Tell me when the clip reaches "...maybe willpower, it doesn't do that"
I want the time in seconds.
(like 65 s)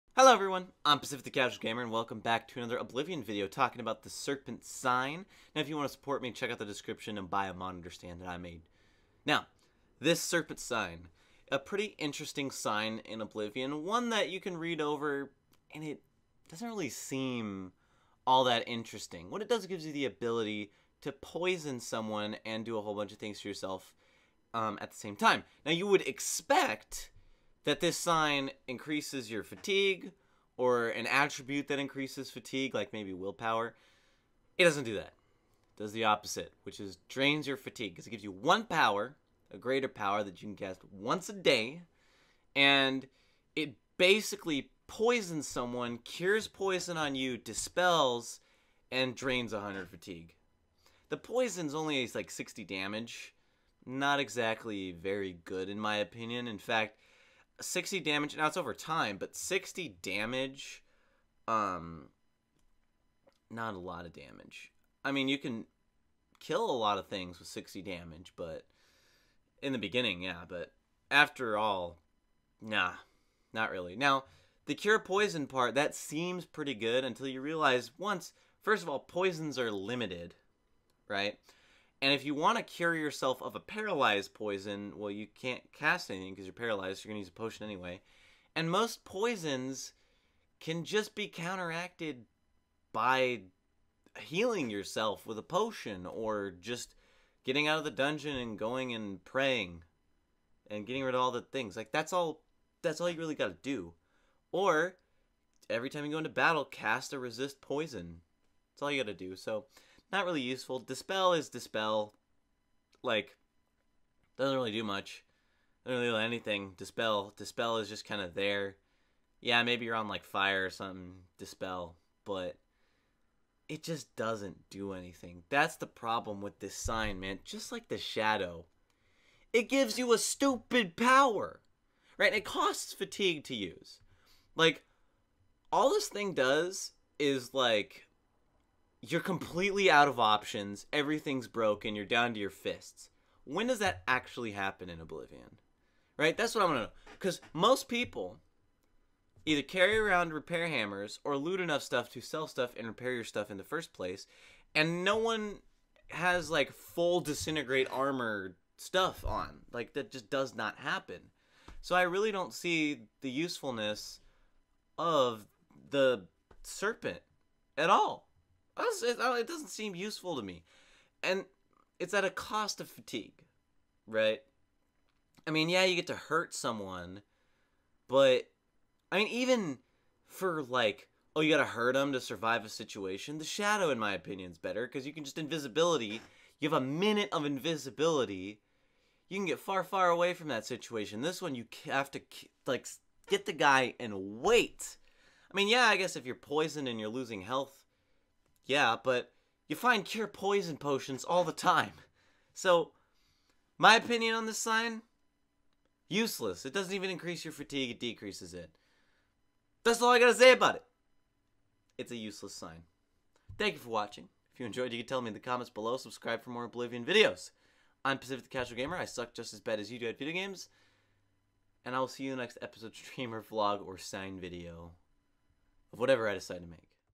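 32 s.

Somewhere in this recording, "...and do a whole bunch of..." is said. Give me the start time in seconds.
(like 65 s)
22 s.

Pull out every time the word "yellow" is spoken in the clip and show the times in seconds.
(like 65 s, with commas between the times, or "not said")
not said.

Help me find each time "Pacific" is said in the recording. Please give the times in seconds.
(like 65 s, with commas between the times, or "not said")
0 s, 218 s.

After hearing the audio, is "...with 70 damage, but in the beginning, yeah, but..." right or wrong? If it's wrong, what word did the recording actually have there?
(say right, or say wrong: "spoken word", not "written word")
wrong: "60", not "70".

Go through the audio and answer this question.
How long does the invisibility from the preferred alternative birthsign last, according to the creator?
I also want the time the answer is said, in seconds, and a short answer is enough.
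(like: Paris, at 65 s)
A minute, at 186 s.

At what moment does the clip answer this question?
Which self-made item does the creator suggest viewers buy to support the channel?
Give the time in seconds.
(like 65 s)
7 s.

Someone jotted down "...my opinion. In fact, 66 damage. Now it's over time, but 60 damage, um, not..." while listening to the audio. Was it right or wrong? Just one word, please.
wrong.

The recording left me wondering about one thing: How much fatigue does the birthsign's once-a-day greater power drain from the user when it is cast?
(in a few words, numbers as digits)
100.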